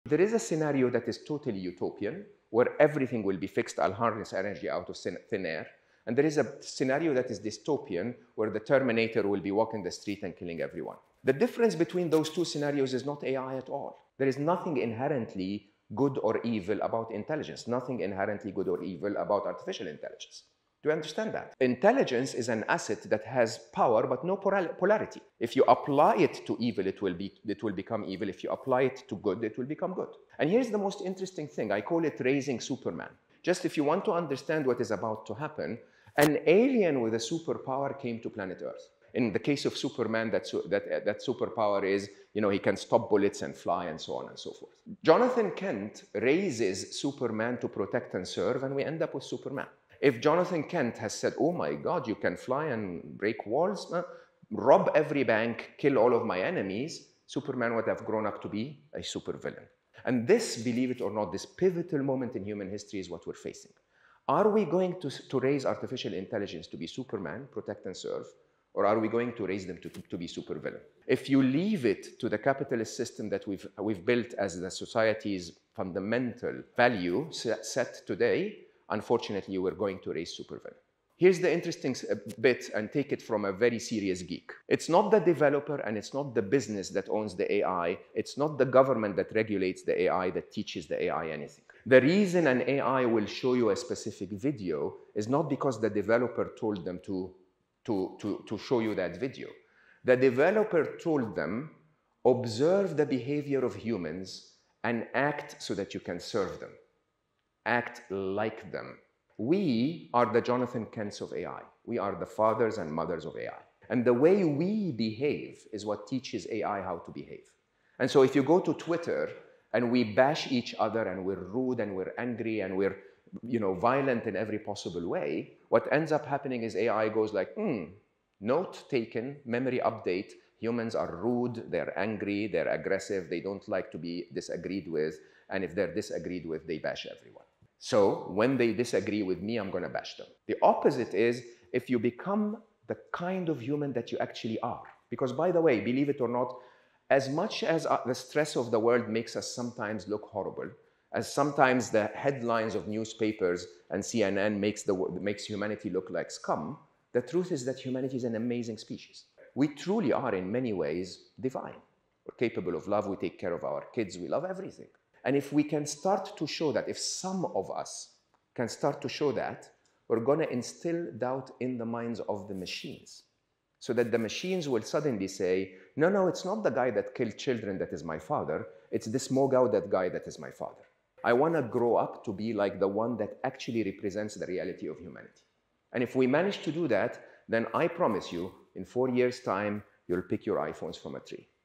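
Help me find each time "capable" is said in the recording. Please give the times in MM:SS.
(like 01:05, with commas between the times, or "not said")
02:42.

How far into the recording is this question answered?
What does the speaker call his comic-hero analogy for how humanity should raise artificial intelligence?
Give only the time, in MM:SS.
00:32.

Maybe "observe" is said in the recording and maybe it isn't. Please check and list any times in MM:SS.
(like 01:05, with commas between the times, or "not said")
01:42.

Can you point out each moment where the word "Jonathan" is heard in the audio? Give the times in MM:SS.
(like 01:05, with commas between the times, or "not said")
00:45, 00:50, 01:50.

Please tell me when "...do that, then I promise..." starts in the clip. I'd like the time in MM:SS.
03:06.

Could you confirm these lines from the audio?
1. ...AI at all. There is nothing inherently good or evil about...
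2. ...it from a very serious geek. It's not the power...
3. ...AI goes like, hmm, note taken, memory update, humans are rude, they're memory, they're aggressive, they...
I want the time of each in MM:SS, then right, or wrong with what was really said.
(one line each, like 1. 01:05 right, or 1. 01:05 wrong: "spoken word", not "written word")
1. 00:13 right
2. 01:23 wrong: "developer", not "power"
3. 02:06 wrong: "angry", not "memory".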